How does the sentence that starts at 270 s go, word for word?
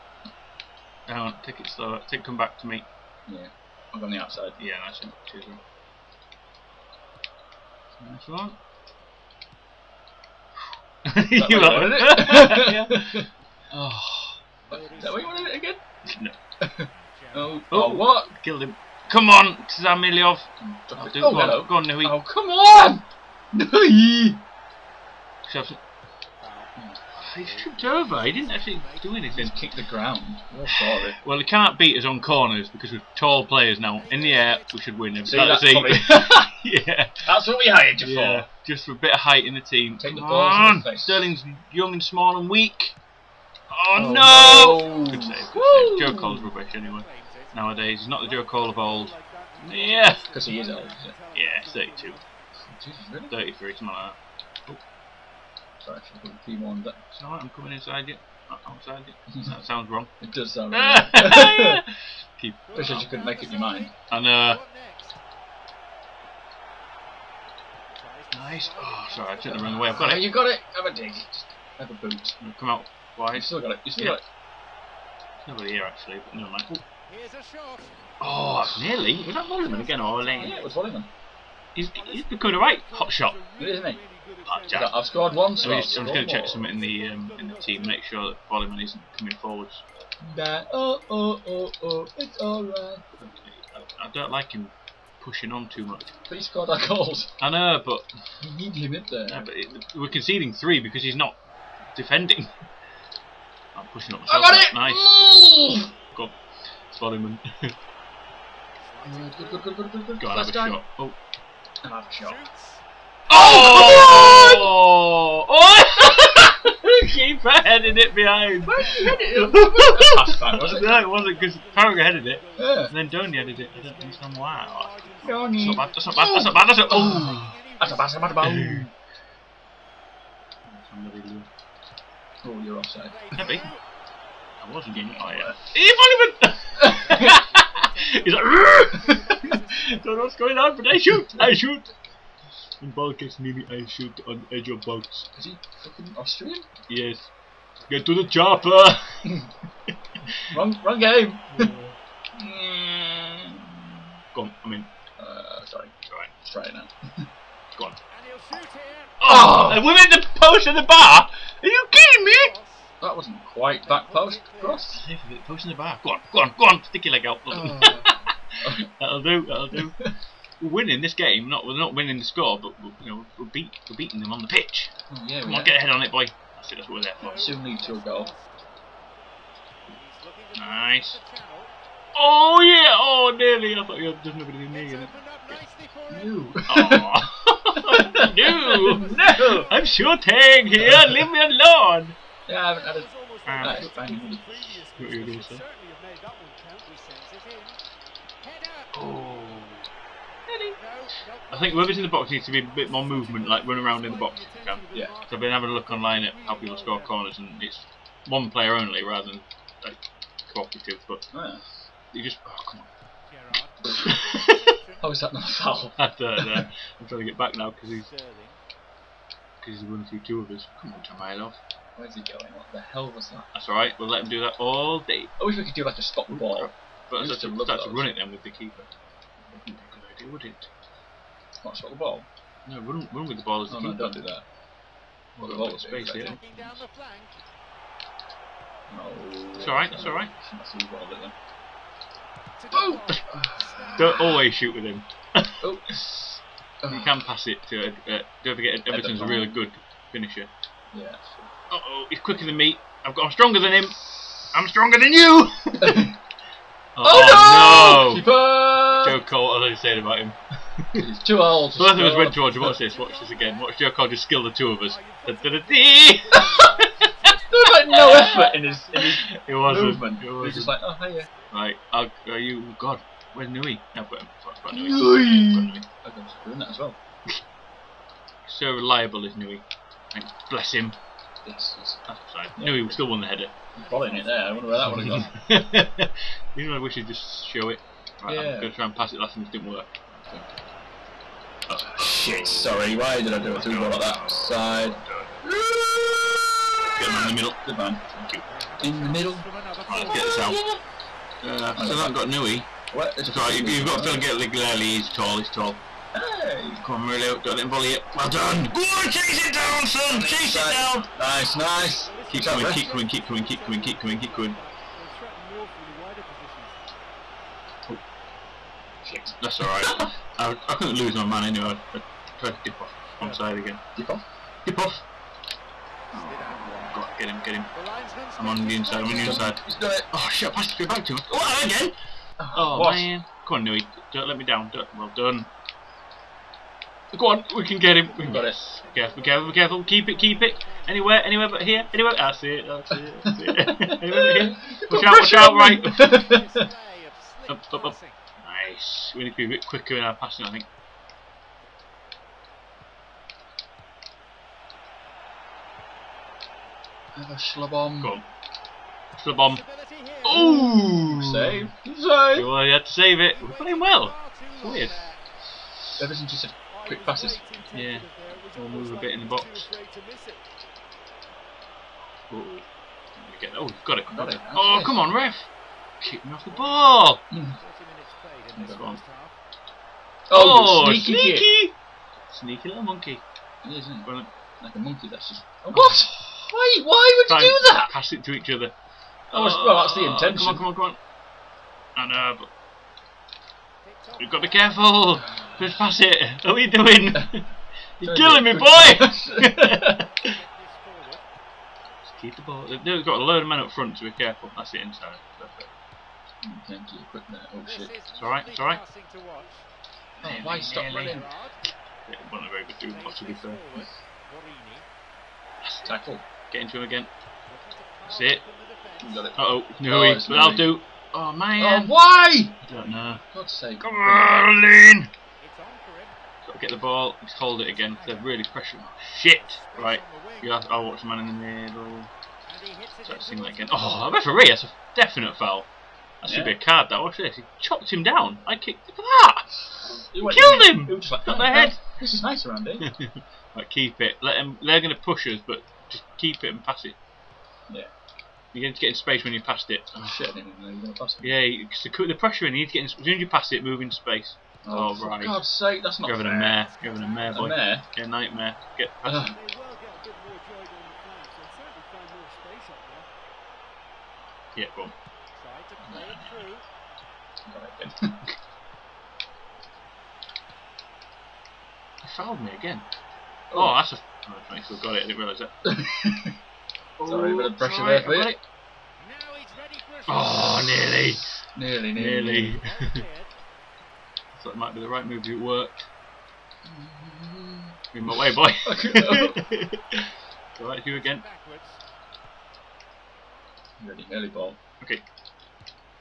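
It was, just like, oh yeah.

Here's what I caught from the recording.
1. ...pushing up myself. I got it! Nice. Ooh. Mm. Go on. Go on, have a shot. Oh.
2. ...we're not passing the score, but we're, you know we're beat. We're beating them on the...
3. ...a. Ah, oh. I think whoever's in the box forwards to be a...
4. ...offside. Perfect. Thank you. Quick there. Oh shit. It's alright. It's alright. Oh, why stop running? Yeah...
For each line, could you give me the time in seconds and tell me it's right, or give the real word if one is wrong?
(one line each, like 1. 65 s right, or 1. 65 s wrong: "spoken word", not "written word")
1. 103 s right
2. 171 s wrong: "winning", not "passing"
3. 192 s wrong: "needs", not "forwards"
4. 404 s wrong: "inside", not "offside".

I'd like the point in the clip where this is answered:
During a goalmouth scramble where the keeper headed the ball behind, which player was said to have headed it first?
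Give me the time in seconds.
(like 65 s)
121 s.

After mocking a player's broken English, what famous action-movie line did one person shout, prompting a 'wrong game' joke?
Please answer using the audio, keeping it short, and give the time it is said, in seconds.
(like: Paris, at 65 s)
Get to the chopper, at 147 s.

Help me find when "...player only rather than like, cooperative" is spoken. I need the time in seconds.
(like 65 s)
208 s.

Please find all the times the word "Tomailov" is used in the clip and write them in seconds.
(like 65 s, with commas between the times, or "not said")
221 s.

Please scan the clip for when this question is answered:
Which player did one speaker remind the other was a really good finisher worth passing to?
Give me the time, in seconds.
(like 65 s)
248 s.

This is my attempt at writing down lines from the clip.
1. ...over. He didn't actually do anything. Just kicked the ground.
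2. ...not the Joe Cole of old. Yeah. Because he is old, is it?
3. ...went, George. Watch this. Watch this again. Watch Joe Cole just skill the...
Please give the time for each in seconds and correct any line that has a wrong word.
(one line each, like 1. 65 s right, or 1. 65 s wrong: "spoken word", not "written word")
1. 27 s right
2. 48 s right
3. 262 s right.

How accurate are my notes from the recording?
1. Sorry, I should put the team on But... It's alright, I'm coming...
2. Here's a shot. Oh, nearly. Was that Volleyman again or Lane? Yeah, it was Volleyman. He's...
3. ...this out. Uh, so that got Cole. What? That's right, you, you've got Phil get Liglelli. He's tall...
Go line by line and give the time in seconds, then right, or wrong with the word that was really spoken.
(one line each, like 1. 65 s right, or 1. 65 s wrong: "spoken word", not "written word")
1. 55 s right
2. 77 s right
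3. 300 s wrong: "Nui", not "Cole".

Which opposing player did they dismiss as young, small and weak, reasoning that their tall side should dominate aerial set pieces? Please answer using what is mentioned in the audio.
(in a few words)
Sterling.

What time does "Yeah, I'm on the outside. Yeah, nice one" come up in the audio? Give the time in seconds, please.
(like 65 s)
3 s.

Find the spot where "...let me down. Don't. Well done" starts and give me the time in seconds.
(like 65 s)
334 s.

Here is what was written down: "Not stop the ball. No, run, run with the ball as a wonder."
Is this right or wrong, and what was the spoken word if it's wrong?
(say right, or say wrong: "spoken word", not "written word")
wrong: "keeper", not "wonder".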